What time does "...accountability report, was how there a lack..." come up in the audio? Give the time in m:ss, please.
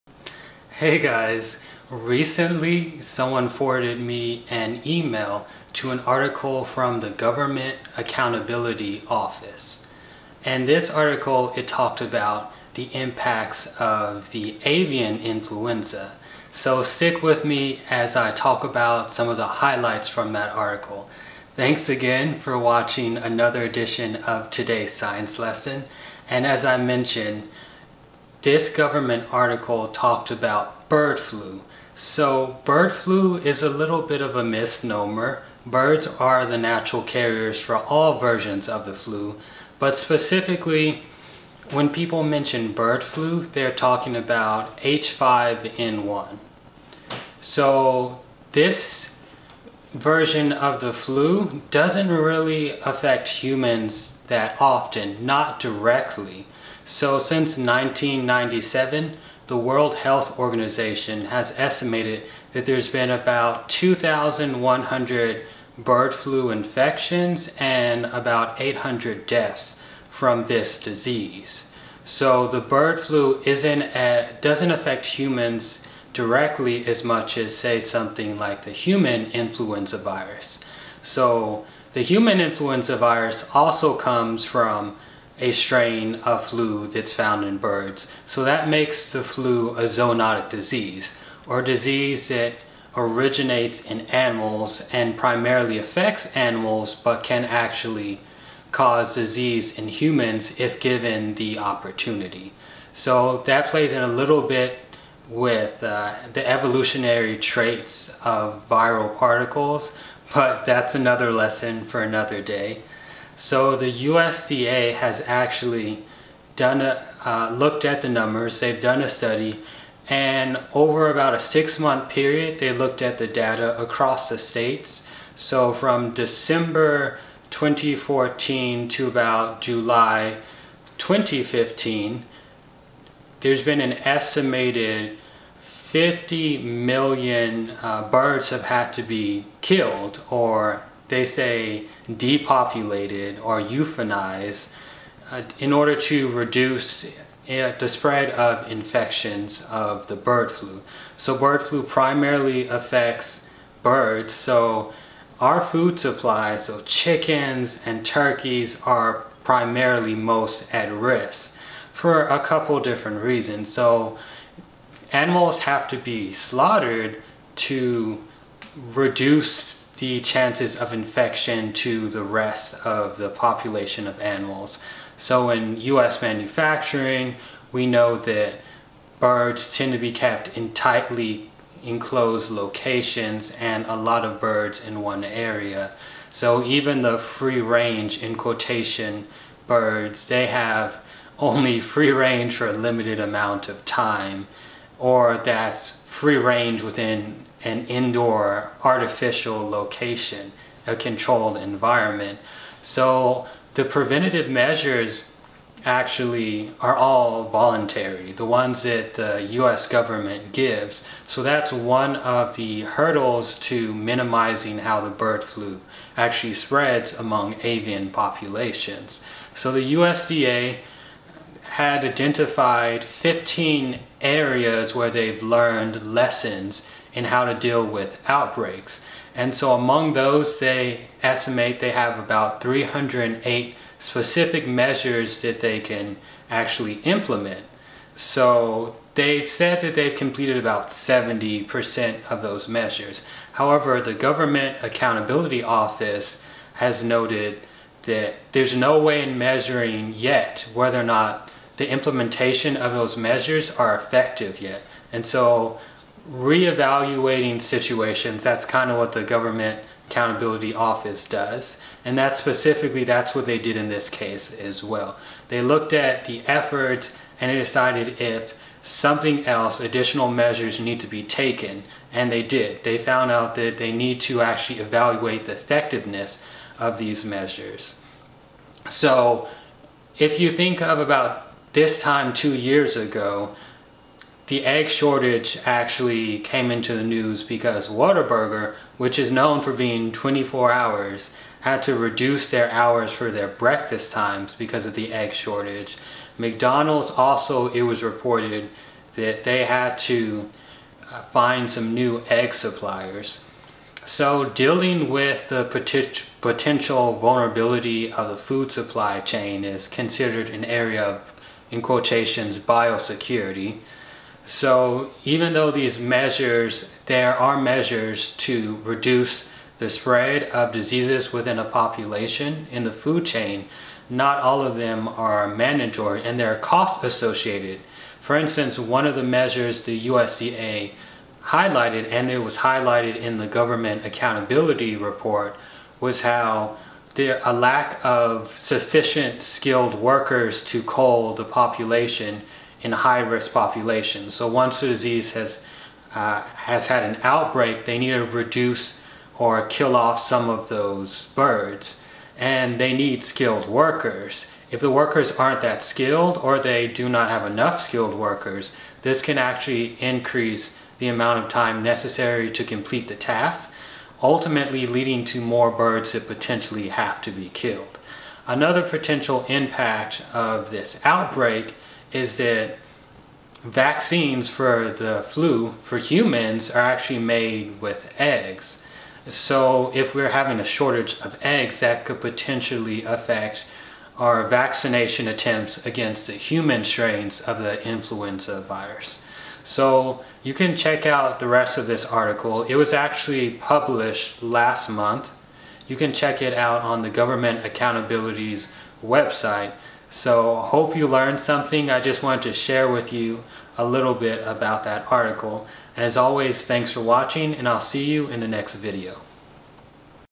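5:34.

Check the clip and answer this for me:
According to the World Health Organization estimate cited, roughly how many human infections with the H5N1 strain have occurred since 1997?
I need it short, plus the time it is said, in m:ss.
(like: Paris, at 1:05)
2,100, at 1:03.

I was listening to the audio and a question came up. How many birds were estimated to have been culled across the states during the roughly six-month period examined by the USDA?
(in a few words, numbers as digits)
50 million.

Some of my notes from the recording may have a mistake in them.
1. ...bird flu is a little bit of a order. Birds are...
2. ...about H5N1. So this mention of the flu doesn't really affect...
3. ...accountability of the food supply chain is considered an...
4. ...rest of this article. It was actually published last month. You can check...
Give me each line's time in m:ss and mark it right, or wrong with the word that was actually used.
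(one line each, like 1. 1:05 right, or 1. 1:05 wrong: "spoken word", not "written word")
1. 0:32 wrong: "misnomer", not "order"
2. 0:44 wrong: "version", not "mention"
3. 5:07 wrong: "vulnerability", not "accountability"
4. 6:31 right.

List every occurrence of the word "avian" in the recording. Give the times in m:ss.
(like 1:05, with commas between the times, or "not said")
0:14, 3:37.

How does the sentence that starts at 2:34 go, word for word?
So our food supply, so chickens and turkeys are primarily most at risk for a couple different reasons.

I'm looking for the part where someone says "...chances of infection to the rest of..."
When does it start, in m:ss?
2:50.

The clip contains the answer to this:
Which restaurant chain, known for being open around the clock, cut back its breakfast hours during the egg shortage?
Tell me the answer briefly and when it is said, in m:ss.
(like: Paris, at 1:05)
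Whataburger, at 4:47.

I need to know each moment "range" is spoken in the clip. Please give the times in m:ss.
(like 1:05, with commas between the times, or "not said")
3:07, 3:12, 3:16.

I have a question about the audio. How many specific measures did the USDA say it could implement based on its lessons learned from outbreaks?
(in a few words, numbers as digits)
308.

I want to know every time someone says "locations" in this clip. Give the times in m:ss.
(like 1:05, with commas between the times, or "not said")
3:02, 3:19.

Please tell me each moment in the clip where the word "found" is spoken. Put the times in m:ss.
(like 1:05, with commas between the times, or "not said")
1:27, 4:32.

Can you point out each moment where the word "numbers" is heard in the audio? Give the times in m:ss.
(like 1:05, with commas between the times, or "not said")
1:58.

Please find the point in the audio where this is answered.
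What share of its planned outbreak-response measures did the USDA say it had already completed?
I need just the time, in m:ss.
4:00.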